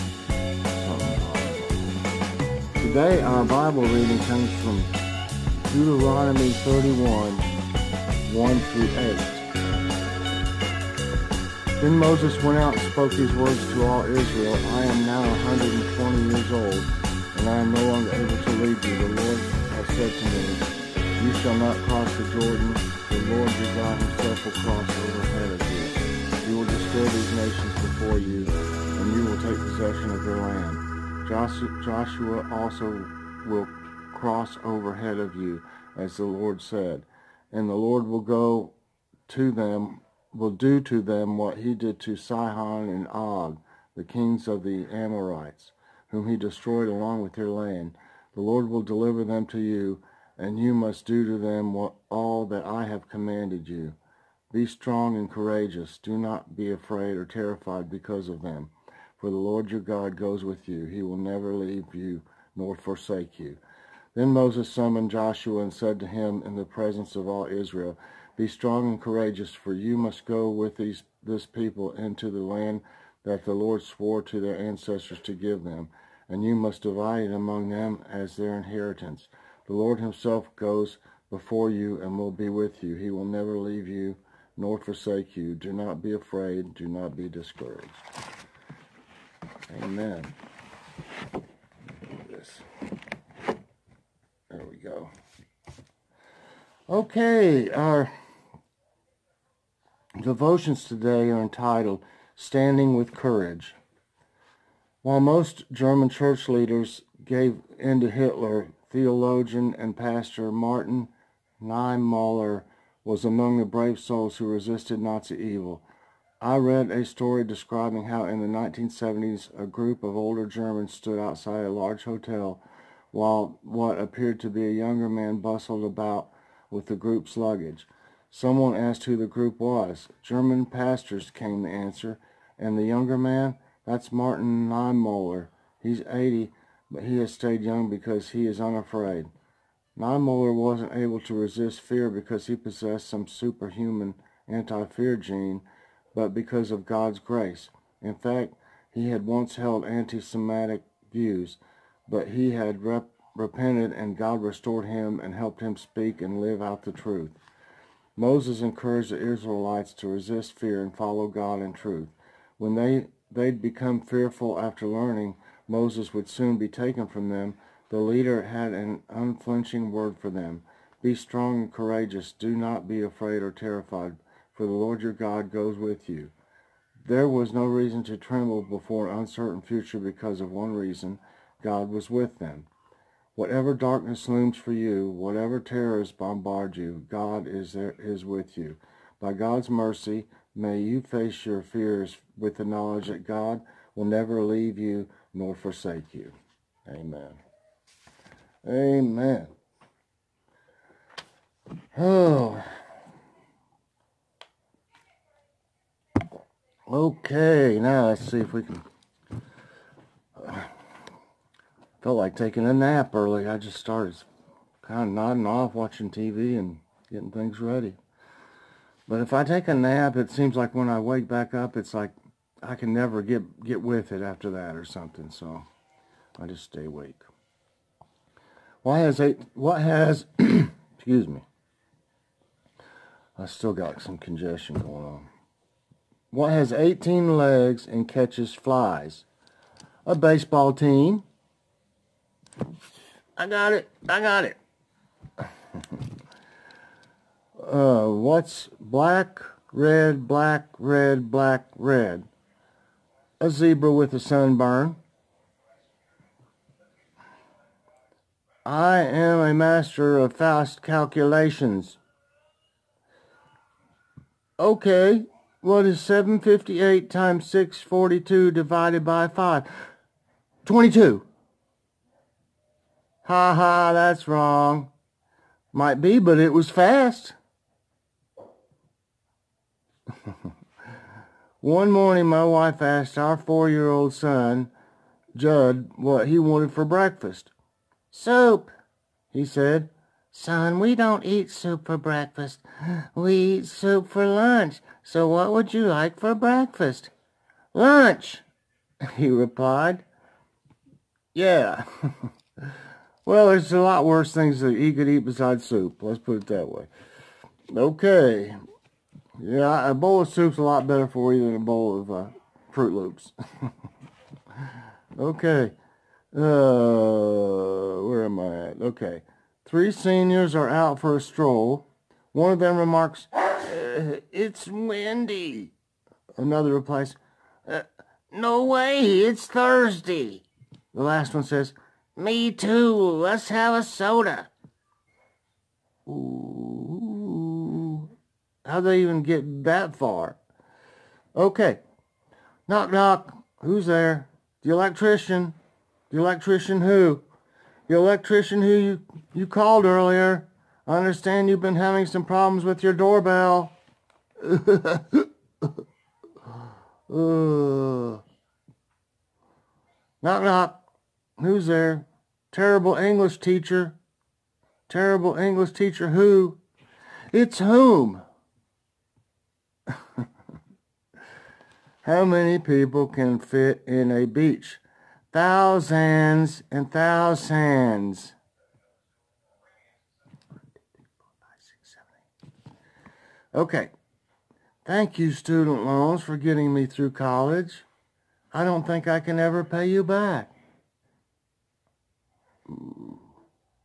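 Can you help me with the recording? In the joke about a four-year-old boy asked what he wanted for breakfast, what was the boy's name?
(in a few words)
Judd.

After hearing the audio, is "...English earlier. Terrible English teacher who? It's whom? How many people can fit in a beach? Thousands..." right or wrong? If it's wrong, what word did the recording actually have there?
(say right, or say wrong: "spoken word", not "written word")
wrong: "teacher", not "earlier".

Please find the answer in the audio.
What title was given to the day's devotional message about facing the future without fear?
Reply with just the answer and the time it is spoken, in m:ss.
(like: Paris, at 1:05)
Standing with Courage, at 1:42.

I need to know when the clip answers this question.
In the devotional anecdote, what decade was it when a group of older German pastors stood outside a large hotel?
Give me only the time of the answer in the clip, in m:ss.
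1:58.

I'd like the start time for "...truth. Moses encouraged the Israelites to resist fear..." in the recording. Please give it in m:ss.
2:36.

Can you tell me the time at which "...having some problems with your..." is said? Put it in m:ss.
5:51.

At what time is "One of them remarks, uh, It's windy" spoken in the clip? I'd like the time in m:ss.
5:22.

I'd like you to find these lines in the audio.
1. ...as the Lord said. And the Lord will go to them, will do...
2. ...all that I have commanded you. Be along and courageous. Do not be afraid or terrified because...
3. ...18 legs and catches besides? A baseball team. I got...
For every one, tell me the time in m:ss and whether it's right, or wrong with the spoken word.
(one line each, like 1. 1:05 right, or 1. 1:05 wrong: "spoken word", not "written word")
1. 0:35 right
2. 0:52 wrong: "strong", not "along"
3. 3:56 wrong: "flies", not "besides".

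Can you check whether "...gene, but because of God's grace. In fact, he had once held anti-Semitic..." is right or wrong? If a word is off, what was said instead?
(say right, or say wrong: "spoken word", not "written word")
right.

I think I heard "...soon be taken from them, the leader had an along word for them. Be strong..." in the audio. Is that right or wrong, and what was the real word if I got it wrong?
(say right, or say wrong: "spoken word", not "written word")
wrong: "unflinching", not "along".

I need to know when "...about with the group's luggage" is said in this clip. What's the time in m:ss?
2:05.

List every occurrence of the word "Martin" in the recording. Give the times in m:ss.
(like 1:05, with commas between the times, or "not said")
1:50, 2:14.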